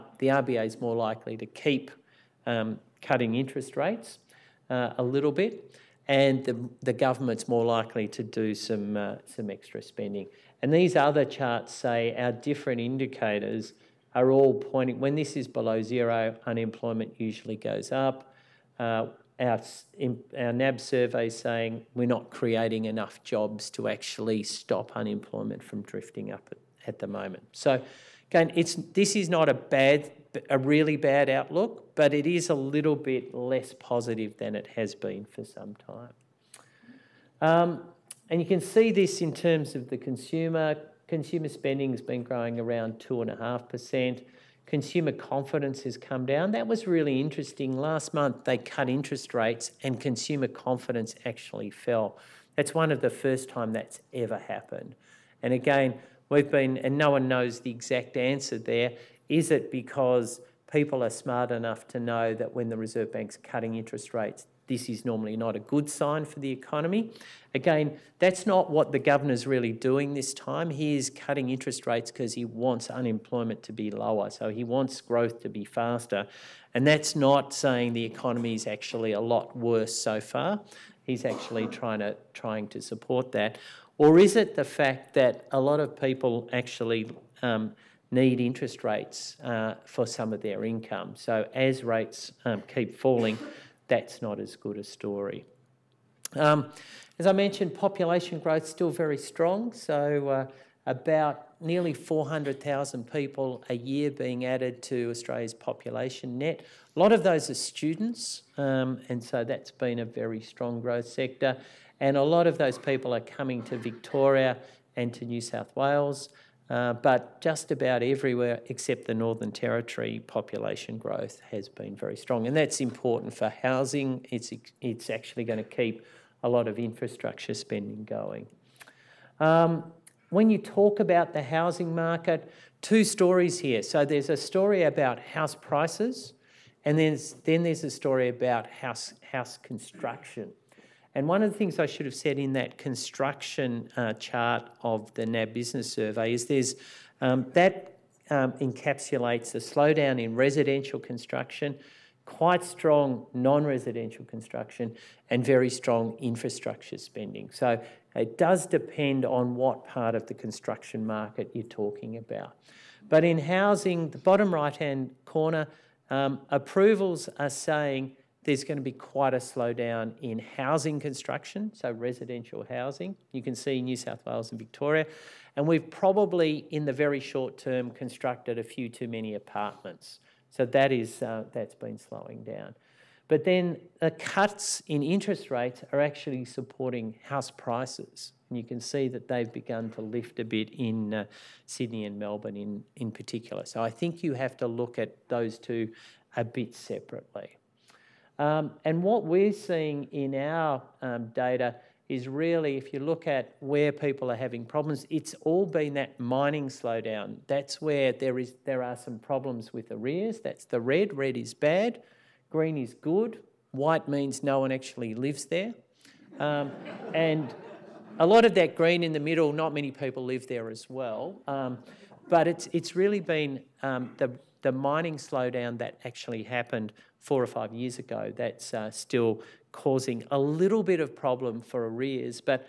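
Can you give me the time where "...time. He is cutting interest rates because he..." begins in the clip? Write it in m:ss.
1:10.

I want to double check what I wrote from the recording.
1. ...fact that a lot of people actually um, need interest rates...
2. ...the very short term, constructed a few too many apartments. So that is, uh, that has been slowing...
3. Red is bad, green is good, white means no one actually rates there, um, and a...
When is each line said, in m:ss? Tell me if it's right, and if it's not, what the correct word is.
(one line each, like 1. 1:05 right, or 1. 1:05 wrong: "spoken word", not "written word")
1. 1:24 right
2. 2:56 right
3. 3:31 wrong: "lives", not "rates".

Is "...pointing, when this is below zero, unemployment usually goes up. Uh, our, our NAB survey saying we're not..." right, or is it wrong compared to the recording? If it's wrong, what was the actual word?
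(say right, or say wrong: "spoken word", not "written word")
right.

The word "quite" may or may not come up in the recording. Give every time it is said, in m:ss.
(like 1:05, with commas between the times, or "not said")
2:32, 2:48.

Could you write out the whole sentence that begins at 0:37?
Um, and you can see this in terms of the consumer.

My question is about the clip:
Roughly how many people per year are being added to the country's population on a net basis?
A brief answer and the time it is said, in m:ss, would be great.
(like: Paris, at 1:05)
nearly 400,000, at 1:41.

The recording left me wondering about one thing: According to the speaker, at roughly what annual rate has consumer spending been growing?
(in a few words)
2.5%.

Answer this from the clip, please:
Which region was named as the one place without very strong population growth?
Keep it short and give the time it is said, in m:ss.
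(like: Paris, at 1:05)
Northern Territory, at 1:59.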